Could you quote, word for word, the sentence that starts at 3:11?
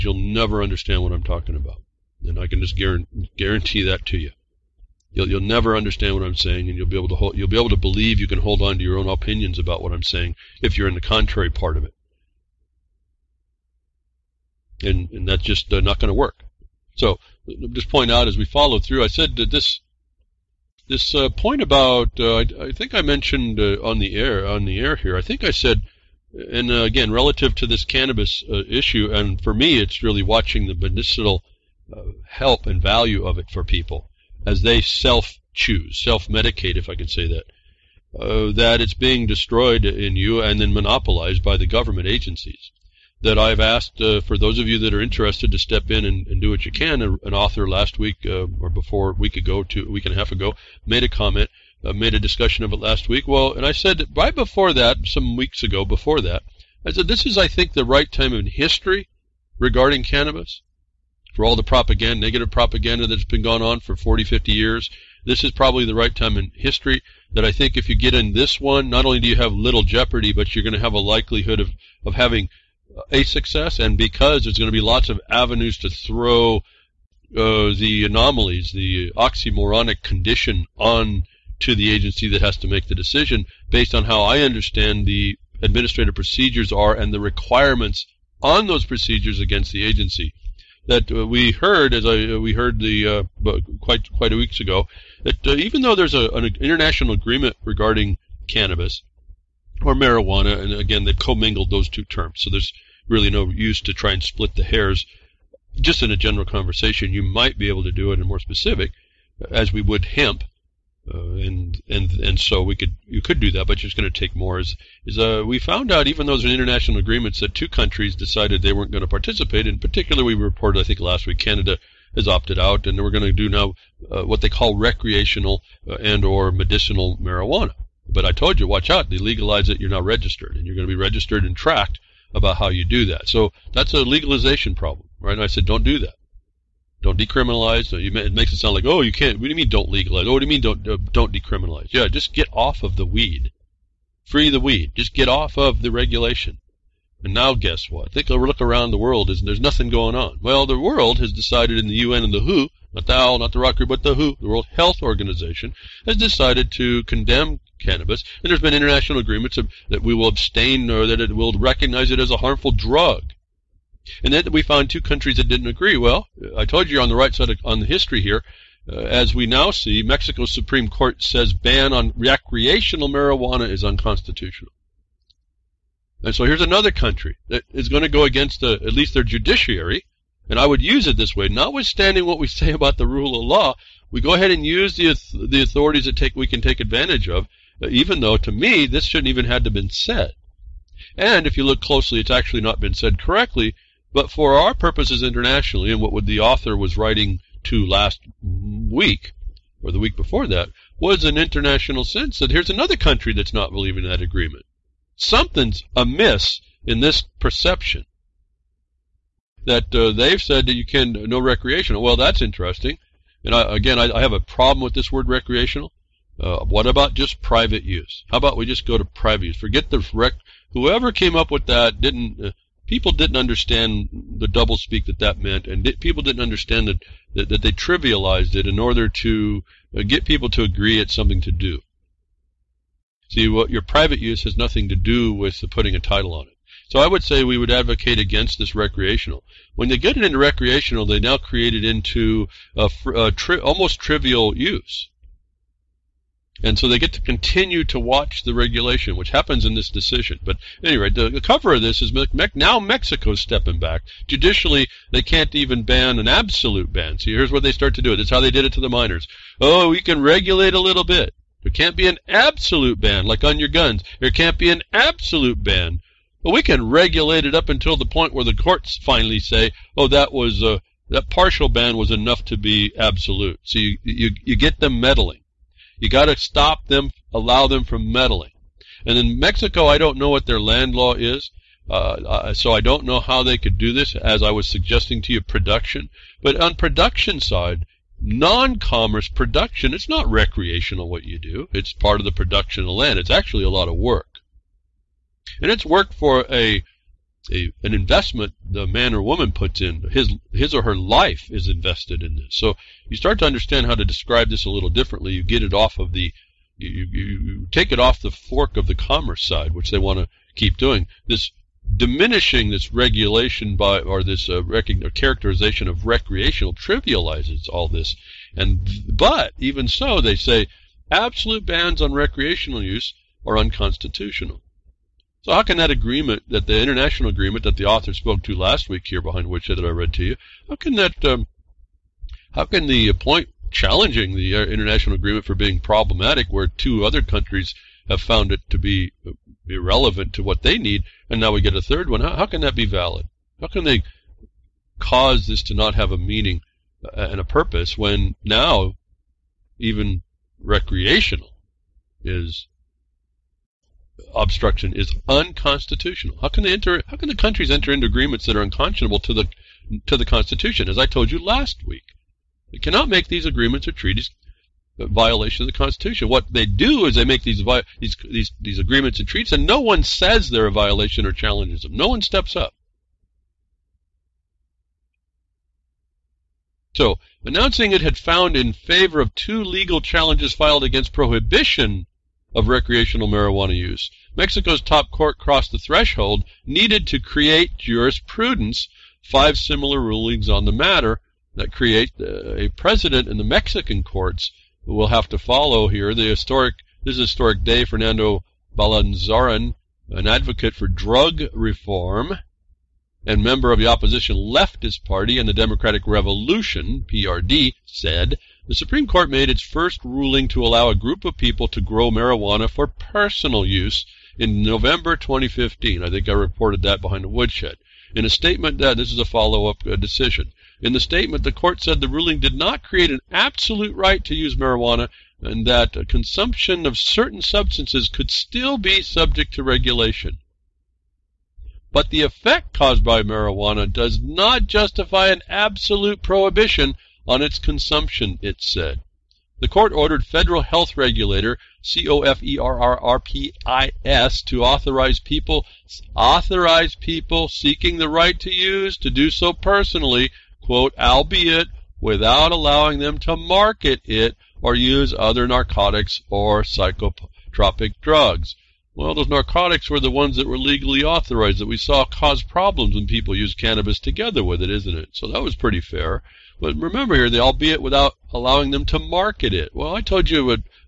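And if you look closely, it's actually not been said correctly.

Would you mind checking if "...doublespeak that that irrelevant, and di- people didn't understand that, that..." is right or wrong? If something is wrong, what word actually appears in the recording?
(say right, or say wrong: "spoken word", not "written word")
wrong: "meant", not "irrelevant".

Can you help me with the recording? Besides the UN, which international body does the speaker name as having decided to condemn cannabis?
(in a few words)
World Health Organization.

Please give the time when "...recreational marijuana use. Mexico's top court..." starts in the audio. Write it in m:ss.
6:22.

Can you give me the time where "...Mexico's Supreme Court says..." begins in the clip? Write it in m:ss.
2:50.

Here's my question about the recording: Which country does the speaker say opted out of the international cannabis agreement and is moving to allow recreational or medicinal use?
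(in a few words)
Canada.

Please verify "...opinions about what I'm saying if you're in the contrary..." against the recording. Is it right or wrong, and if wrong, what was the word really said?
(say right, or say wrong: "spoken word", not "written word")
right.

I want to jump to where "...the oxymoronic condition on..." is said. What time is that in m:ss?
1:18.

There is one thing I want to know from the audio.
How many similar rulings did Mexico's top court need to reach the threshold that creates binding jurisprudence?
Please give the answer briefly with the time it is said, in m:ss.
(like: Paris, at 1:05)
5, at 6:29.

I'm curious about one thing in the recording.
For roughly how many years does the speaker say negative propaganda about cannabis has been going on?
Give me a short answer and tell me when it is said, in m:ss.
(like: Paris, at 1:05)
40, 50 years, at 1:03.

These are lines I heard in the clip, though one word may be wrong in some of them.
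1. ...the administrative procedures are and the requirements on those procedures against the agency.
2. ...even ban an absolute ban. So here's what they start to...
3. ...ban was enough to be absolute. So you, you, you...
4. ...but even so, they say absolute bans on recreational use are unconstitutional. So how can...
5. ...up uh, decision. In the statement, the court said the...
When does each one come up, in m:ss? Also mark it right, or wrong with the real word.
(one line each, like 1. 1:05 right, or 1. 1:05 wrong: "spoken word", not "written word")
1. 1:25 right
2. 4:15 right
3. 4:31 right
4. 5:19 right
5. 6:59 right.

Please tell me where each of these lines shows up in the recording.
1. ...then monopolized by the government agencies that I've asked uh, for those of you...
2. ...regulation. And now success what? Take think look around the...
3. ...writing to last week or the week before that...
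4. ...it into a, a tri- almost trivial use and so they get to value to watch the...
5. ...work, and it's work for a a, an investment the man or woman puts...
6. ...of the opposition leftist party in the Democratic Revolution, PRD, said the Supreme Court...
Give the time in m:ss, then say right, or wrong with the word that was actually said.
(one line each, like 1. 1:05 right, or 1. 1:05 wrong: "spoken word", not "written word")
1. 0:40 right
2. 2:25 wrong: "guess", not "success"
3. 3:16 right
4. 4:01 wrong: "continue", not "value"
5. 4:53 right
6. 6:43 right.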